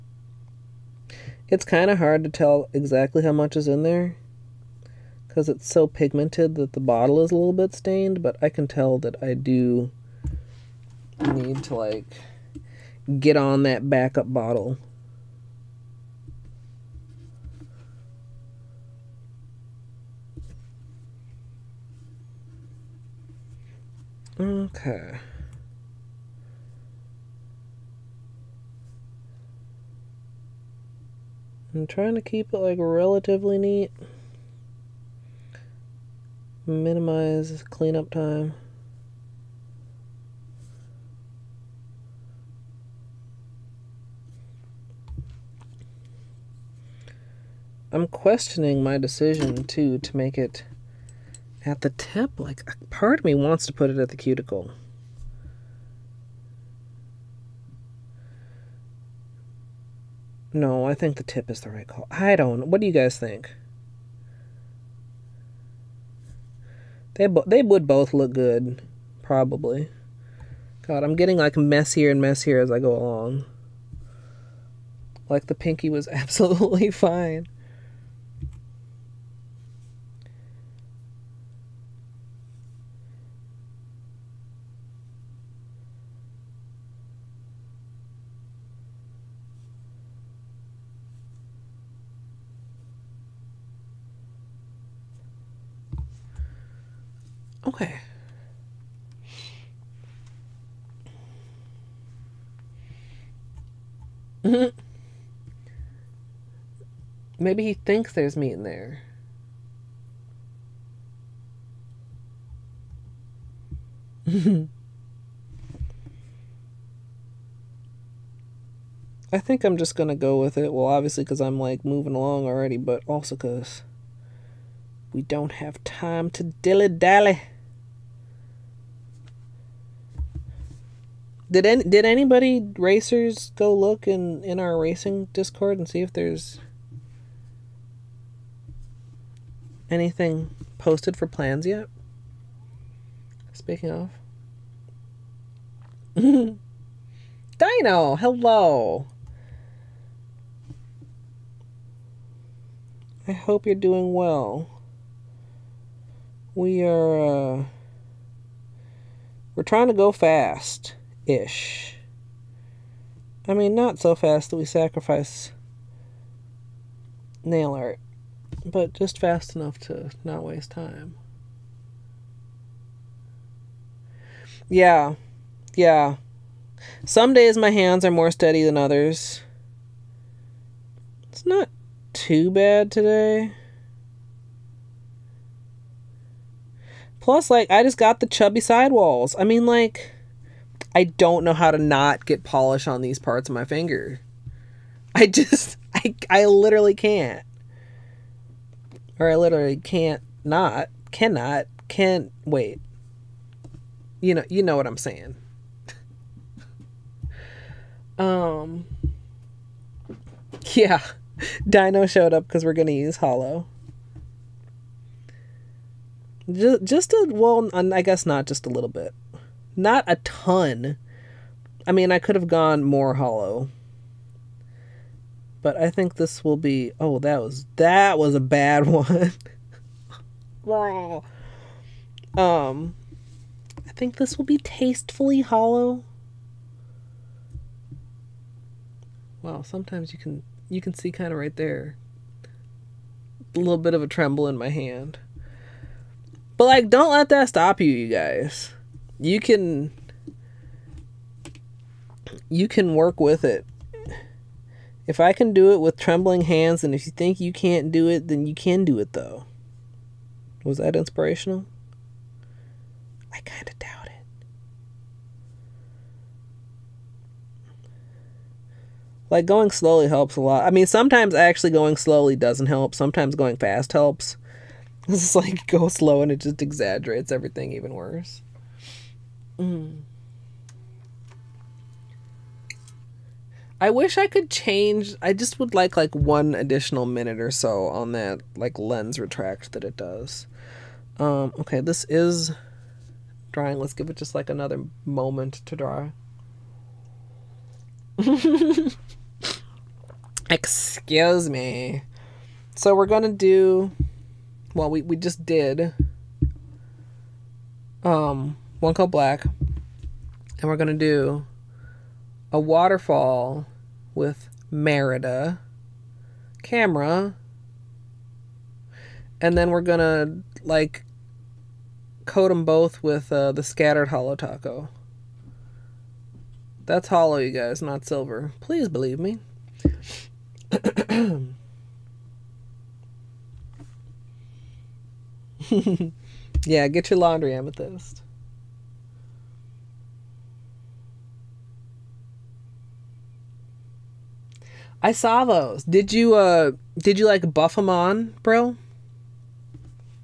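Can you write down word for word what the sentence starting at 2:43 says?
I mean, not so fast that we sacrifice nail art, but just fast enough to not waste time.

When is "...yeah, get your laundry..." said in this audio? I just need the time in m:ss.
5:36.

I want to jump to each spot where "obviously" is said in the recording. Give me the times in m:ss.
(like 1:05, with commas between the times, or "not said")
2:00.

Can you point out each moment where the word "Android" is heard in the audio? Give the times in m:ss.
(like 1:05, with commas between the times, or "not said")
not said.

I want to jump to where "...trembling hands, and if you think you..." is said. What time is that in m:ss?
4:15.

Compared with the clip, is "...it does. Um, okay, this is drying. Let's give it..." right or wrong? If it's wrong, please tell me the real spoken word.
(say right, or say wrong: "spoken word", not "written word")
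right.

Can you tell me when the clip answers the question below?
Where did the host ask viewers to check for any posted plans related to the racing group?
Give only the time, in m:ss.
2:15.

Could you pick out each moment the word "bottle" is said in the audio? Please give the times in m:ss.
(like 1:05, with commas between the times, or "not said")
0:06, 0:14.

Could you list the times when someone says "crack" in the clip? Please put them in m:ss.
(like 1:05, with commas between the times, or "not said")
not said.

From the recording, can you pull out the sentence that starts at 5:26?
That's hollow, you guys, not silver.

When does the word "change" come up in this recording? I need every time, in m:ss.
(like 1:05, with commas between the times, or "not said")
4:44.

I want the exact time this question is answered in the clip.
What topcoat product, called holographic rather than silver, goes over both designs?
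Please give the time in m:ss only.
5:23.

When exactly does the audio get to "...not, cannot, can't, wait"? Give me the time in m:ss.
3:20.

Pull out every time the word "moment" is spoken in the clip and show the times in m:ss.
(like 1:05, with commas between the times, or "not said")
4:55.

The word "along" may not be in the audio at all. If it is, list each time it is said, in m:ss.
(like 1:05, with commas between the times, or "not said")
1:12, 2:02.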